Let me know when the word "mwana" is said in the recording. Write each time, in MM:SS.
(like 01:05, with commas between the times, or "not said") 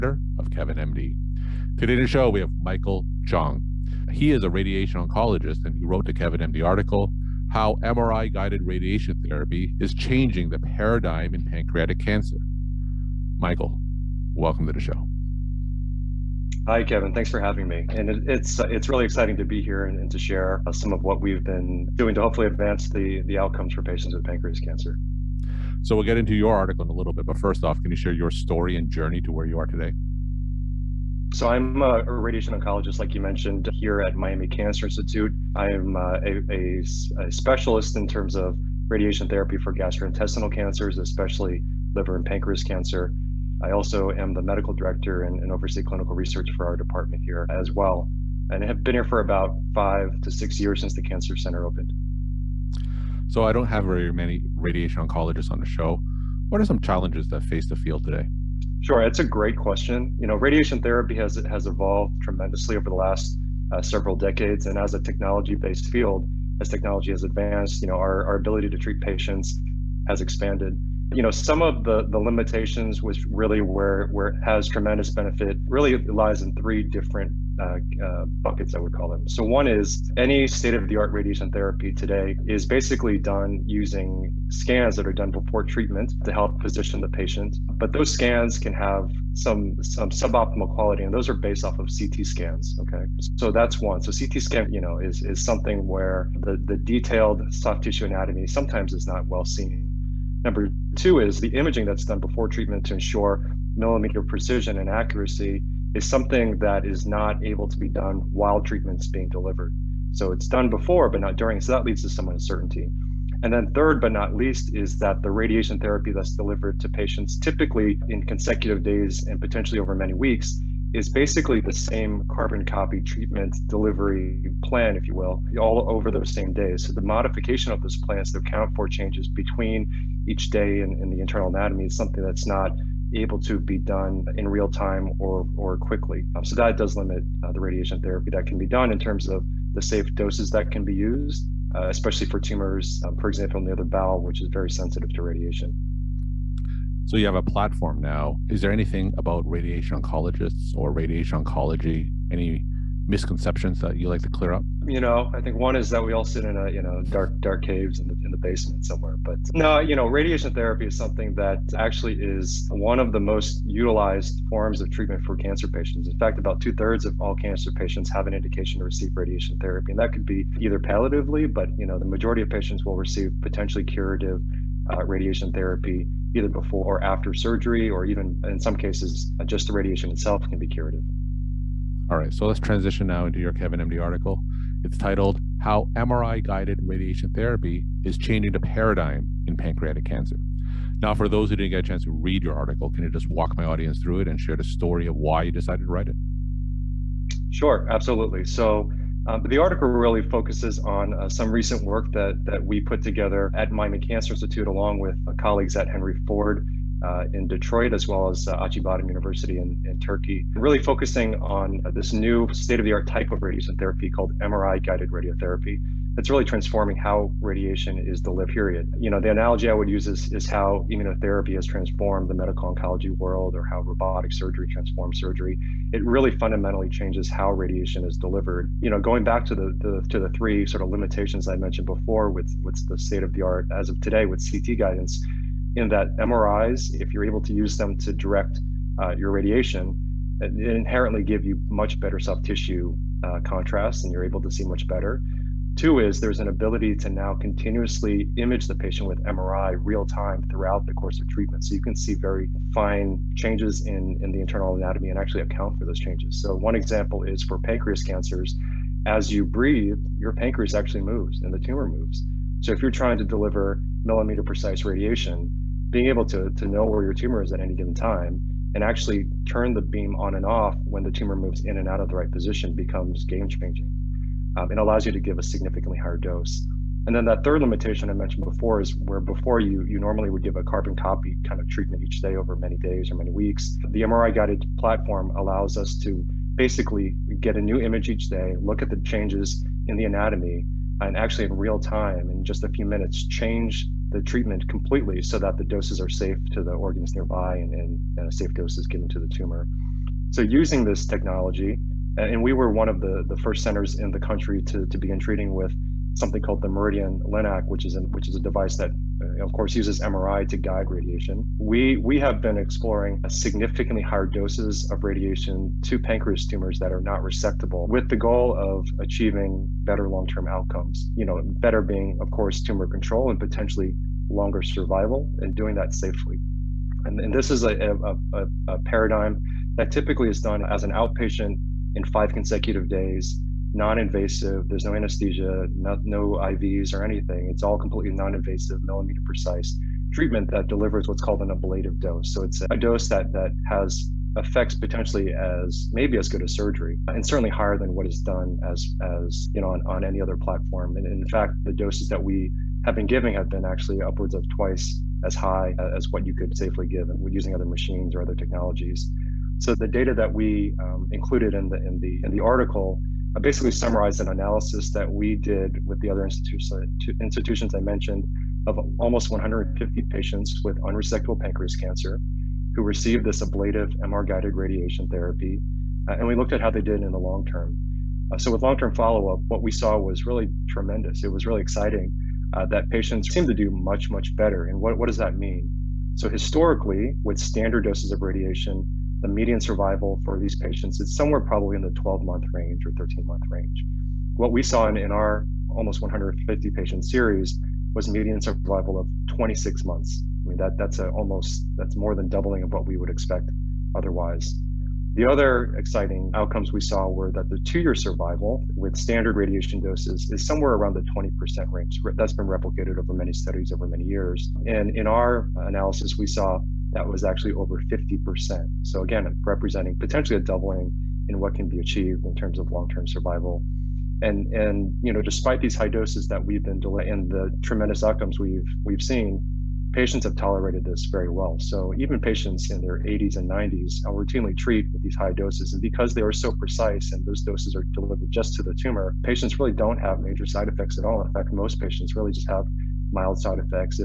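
not said.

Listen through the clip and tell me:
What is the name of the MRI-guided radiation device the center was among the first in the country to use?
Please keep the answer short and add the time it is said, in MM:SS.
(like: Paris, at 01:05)
MRIdian LINAC, at 05:06.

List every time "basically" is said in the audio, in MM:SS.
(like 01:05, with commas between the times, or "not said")
01:22, 02:01, 04:46, 06:03.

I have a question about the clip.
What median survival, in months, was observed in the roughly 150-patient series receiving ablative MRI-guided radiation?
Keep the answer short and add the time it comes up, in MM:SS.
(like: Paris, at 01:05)
26 months, at 06:39.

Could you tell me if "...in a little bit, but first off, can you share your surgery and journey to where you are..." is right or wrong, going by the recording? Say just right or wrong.
wrong.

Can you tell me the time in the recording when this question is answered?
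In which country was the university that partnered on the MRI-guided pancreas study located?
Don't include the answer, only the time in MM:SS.
03:29.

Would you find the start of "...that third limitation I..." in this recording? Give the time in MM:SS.
04:37.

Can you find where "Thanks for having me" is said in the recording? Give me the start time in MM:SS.
00:17.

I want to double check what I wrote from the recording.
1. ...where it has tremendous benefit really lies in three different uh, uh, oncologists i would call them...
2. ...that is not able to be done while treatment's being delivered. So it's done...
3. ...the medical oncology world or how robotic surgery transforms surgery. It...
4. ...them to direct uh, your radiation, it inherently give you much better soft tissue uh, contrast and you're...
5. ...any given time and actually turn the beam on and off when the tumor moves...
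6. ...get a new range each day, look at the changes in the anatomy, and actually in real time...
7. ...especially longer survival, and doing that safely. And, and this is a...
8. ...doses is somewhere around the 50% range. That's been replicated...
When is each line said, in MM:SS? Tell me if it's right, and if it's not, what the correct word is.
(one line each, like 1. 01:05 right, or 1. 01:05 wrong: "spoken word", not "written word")
1. 01:14 wrong: "buckets", not "oncologists"
2. 01:46 right
3. 03:42 right
4. 03:57 right
5. 04:27 right
6. 04:47 wrong: "image", not "range"
7. 05:23 wrong: "potentially", not "especially"
8. 06:49 wrong: "20", not "50".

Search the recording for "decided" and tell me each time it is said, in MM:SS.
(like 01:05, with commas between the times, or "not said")
03:15.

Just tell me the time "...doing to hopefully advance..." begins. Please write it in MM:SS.
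00:21.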